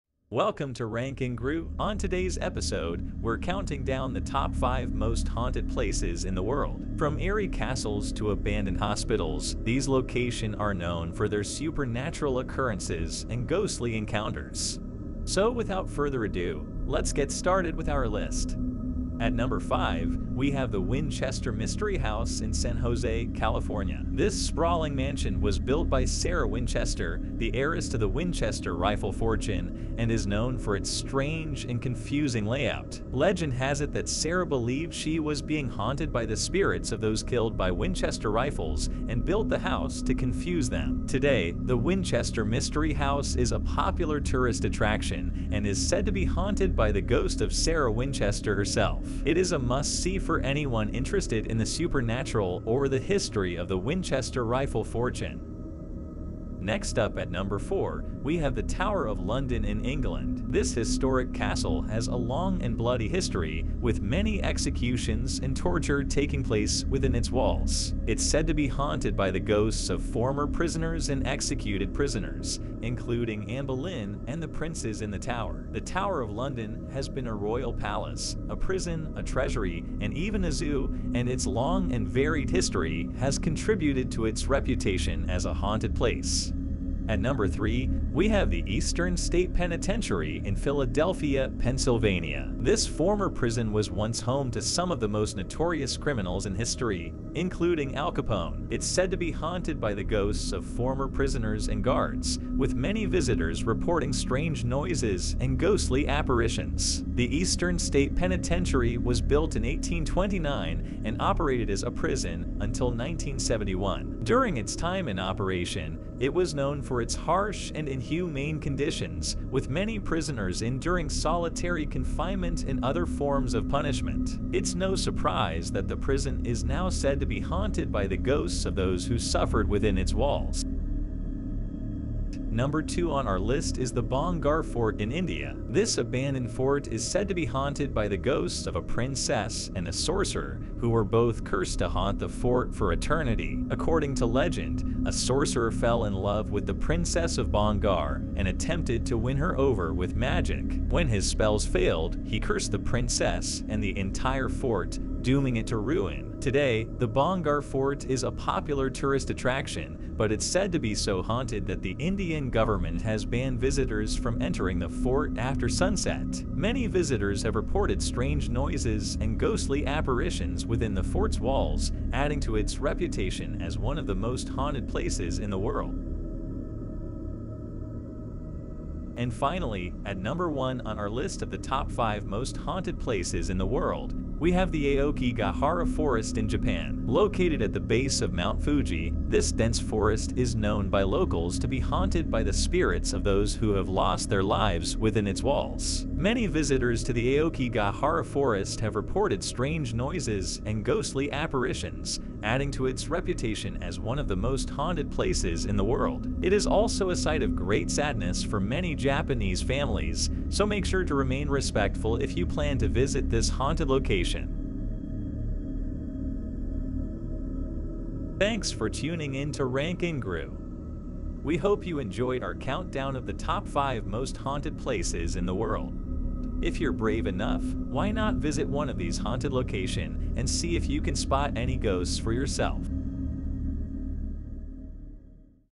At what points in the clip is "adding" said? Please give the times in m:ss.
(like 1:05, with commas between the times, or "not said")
2:52, 3:22.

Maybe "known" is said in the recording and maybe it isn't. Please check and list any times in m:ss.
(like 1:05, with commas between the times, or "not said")
0:10, 0:30, 1:56, 3:10.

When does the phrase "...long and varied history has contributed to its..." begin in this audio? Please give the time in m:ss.
1:21.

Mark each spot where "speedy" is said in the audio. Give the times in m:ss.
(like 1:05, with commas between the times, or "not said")
not said.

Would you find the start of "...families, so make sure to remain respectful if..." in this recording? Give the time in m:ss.
3:29.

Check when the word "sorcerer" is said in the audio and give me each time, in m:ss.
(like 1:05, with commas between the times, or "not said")
2:19, 2:25.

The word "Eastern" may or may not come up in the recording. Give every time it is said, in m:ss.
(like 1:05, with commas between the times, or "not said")
1:28, 1:47.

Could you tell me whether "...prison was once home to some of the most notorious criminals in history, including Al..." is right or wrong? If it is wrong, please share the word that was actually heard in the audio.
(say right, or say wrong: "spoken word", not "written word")
right.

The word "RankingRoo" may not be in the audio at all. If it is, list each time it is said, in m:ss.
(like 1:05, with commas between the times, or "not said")
0:00, 3:39.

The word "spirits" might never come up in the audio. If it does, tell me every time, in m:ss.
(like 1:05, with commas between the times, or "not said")
0:36, 3:12.